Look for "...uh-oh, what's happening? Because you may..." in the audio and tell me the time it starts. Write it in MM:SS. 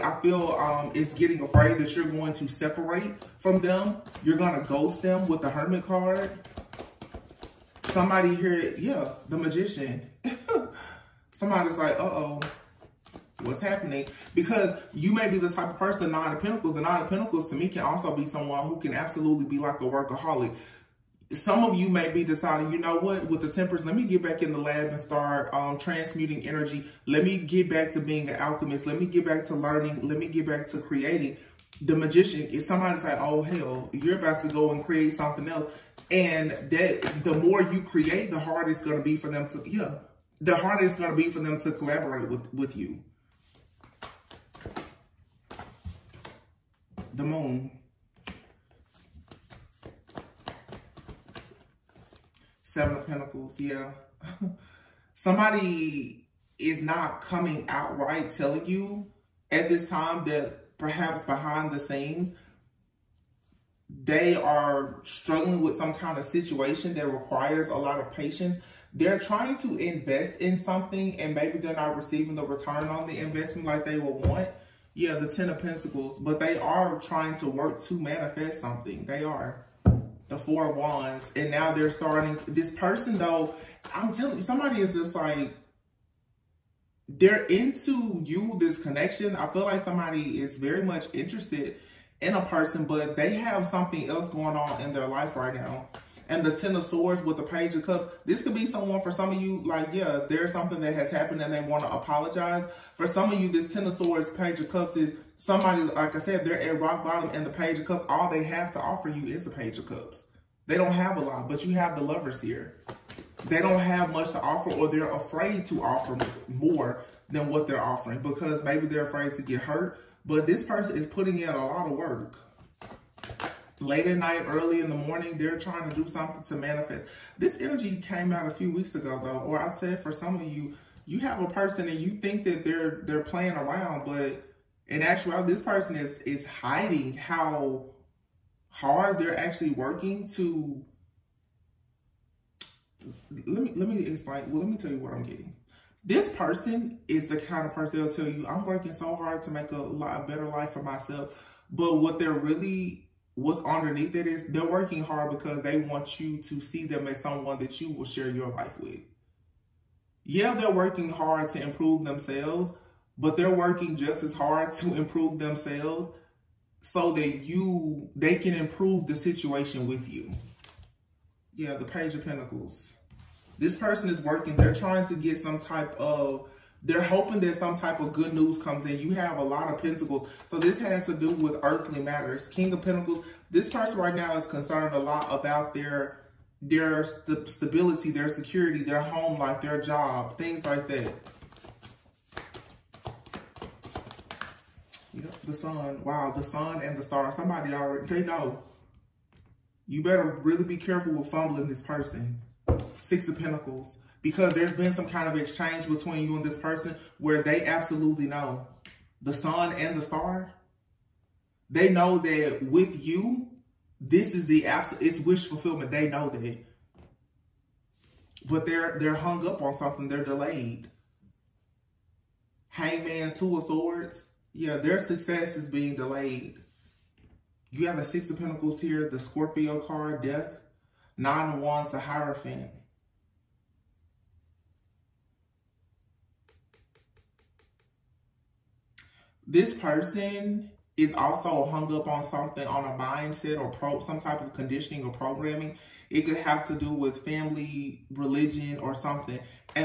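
00:11.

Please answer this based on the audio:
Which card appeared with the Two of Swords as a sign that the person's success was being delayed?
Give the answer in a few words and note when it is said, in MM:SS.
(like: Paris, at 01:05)
Hangman, at 03:42.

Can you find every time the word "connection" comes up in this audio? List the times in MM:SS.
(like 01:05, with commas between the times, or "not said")
01:28.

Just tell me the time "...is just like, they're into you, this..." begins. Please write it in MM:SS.
01:24.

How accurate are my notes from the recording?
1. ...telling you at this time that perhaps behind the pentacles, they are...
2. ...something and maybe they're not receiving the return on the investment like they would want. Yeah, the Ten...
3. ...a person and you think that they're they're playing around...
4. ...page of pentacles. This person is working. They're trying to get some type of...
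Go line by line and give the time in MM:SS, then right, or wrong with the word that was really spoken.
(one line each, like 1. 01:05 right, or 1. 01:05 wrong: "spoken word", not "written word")
1. 00:58 wrong: "scenes", not "pentacles"
2. 01:10 right
3. 02:11 right
4. 02:51 right.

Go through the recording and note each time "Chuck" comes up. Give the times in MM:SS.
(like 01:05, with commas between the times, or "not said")
not said.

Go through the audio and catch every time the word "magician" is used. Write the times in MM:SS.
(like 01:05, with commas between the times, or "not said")
00:09, 00:31.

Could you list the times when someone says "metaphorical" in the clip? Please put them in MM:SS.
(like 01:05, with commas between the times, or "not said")
not said.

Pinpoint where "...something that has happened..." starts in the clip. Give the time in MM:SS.
01:40.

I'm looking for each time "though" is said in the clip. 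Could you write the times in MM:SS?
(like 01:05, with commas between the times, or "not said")
01:23, 02:09.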